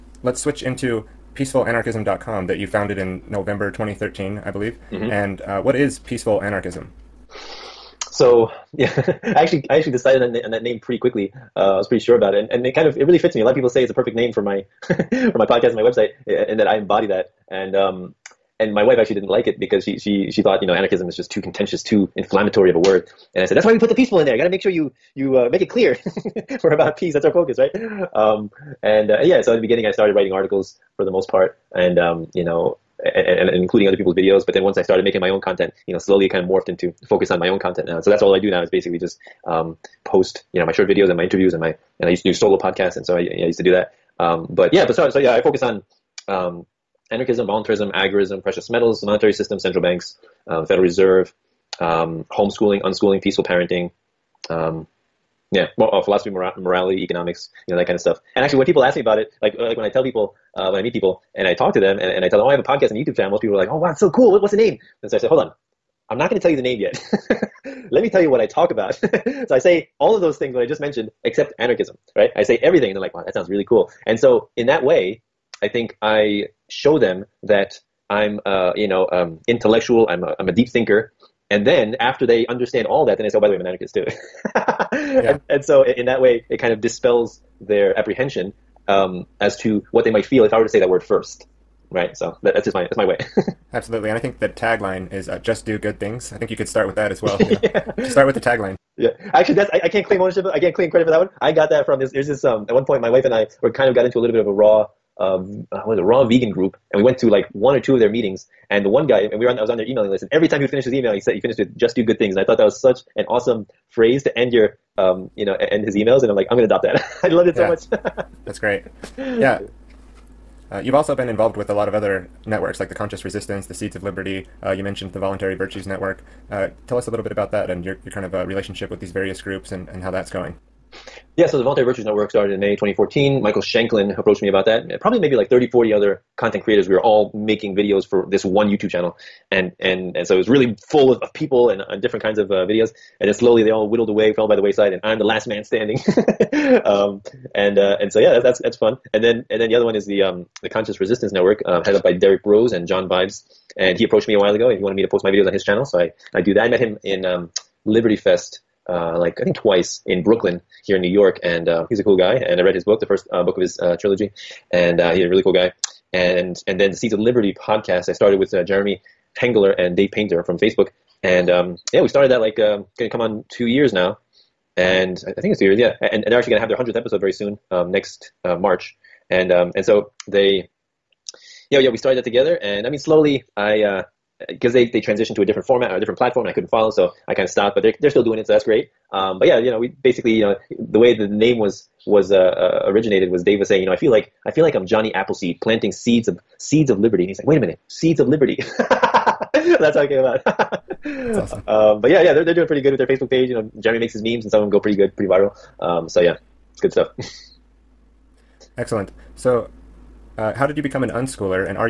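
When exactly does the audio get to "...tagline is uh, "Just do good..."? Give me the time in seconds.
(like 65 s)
94 s.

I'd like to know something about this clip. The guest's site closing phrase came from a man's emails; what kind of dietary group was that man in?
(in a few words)
raw vegan group.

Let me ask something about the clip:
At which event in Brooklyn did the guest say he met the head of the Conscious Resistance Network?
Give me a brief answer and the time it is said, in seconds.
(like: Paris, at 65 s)
Liberty Fest, at 157 s.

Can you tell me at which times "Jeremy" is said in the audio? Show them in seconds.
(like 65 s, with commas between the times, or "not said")
168 s, 203 s.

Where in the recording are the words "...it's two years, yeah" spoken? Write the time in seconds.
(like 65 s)
175 s.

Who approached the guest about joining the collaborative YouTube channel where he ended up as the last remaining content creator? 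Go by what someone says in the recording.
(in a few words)
Michael Shanklin.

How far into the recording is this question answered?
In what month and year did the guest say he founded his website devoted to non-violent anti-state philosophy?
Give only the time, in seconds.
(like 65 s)
3 s.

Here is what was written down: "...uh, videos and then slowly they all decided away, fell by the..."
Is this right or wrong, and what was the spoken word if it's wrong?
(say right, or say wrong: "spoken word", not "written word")
wrong: "whittled", not "decided".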